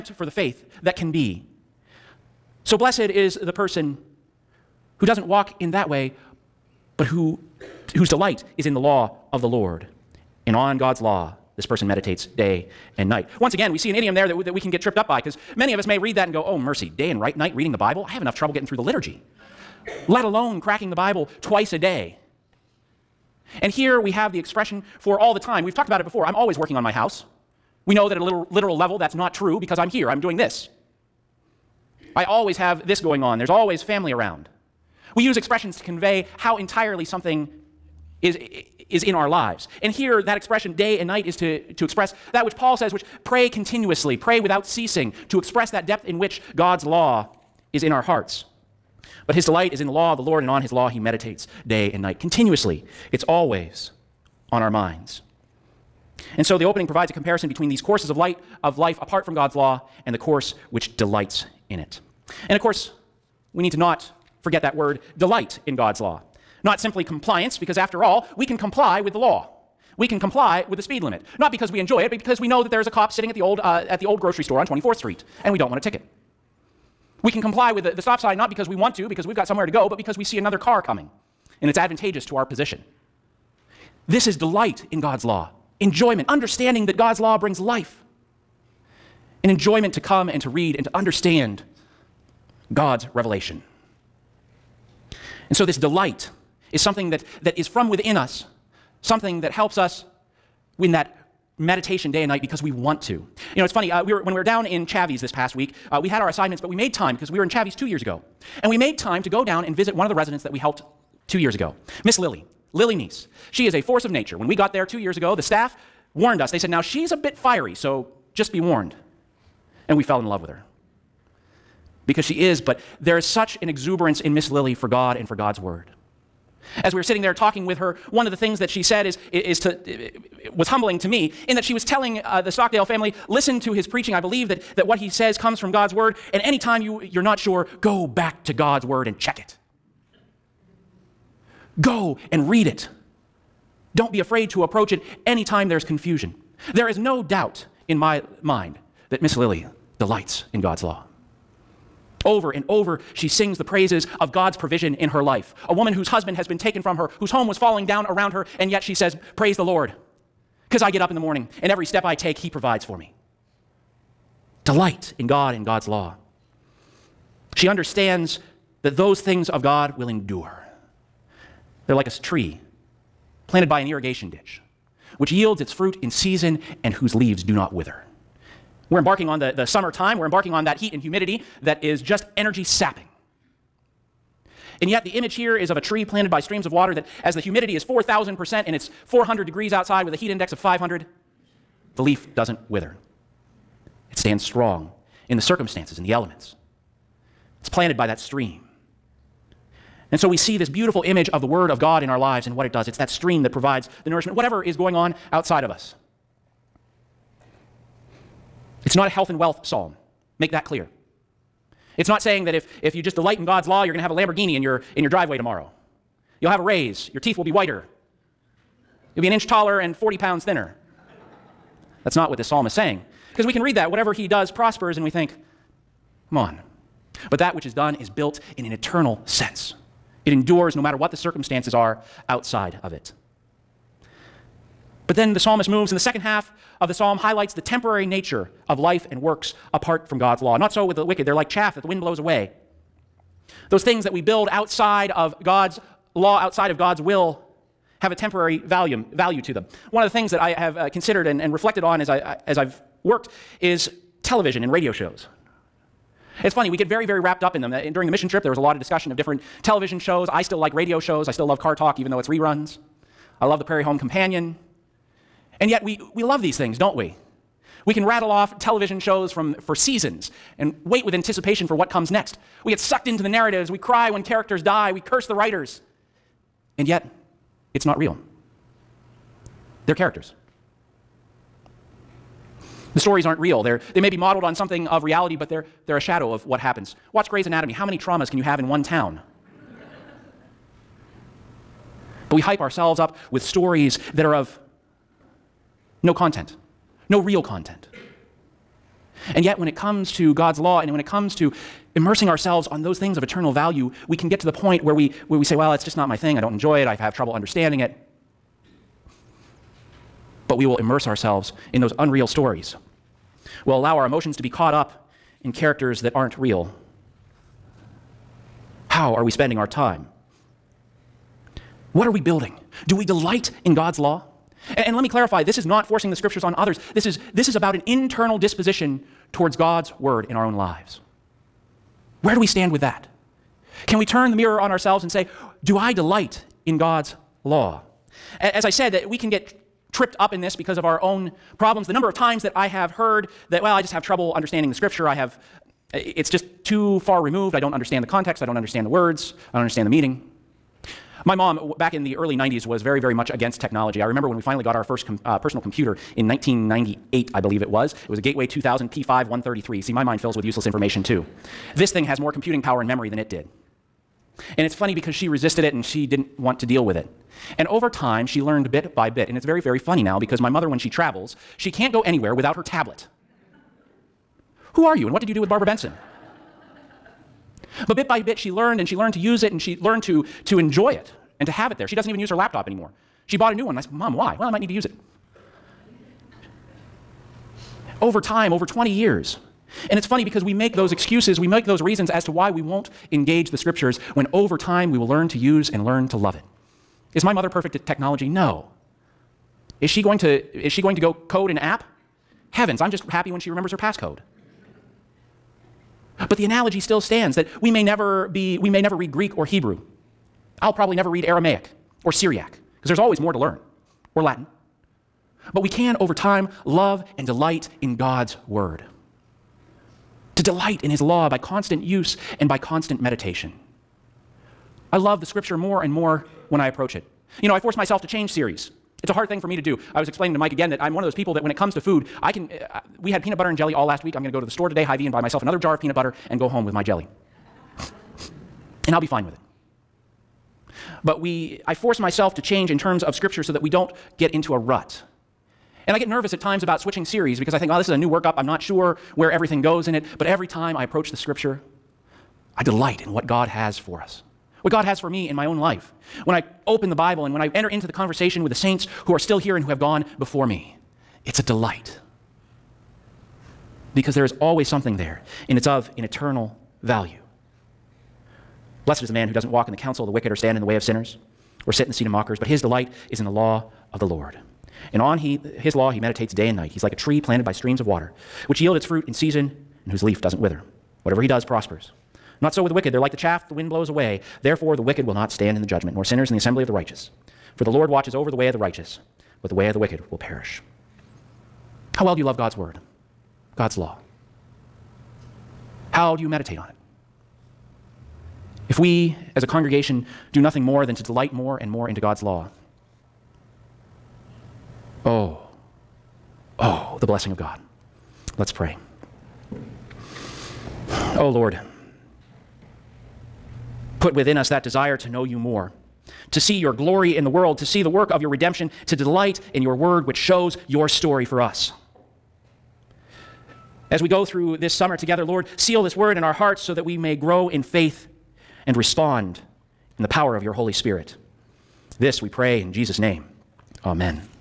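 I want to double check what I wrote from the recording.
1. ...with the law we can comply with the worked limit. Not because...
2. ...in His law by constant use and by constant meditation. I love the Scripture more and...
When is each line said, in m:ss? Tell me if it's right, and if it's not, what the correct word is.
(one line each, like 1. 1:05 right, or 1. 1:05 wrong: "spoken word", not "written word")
1. 1:09 wrong: "speed", not "worked"
2. 7:00 right.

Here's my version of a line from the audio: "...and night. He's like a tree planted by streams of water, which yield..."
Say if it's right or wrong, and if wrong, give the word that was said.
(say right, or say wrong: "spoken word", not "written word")
right.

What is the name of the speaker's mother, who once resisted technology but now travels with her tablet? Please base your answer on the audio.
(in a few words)
Barbara Benson.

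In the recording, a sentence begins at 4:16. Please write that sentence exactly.
It's funny, we get very, very wrapped up in them.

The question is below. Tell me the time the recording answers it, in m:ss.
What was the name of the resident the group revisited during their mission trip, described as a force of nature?
1:52.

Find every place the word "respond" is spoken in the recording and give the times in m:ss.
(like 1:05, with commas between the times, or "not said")
8:48.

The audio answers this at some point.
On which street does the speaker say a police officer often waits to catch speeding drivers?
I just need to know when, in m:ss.
1:14.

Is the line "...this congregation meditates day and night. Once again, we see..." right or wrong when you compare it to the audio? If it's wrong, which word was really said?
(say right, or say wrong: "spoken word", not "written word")
wrong: "person", not "congregation".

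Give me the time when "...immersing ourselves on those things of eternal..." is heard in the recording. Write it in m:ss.
5:01.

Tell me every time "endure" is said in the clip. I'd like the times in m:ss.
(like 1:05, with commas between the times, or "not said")
2:50, 3:50.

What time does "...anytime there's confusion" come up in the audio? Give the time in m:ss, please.
2:25.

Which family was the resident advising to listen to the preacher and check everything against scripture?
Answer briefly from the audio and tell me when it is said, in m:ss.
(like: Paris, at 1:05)
Stockdale, at 2:12.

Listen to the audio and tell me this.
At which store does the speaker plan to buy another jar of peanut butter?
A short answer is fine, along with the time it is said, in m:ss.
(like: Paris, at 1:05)
Hy-Vee, at 7:14.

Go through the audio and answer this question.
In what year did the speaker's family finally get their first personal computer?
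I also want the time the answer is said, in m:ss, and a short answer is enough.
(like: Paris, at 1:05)
1998, at 5:56.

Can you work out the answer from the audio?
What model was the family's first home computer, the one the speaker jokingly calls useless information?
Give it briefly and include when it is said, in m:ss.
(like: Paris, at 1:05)
Gateway 2000 P5 133, at 5:58.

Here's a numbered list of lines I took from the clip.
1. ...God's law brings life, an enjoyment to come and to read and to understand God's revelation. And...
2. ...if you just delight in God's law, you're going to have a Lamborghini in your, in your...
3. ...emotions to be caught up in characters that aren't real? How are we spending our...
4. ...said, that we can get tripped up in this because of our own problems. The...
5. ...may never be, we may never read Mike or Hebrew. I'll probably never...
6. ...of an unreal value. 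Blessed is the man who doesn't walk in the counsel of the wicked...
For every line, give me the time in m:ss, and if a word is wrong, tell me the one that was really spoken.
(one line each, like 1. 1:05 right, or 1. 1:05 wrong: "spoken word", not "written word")
1. 1:26 right
2. 3:32 right
3. 5:14 right
4. 5:38 right
5. 6:47 wrong: "Greek", not "Mike"
6. 7:45 wrong: "eternal", not "unreal".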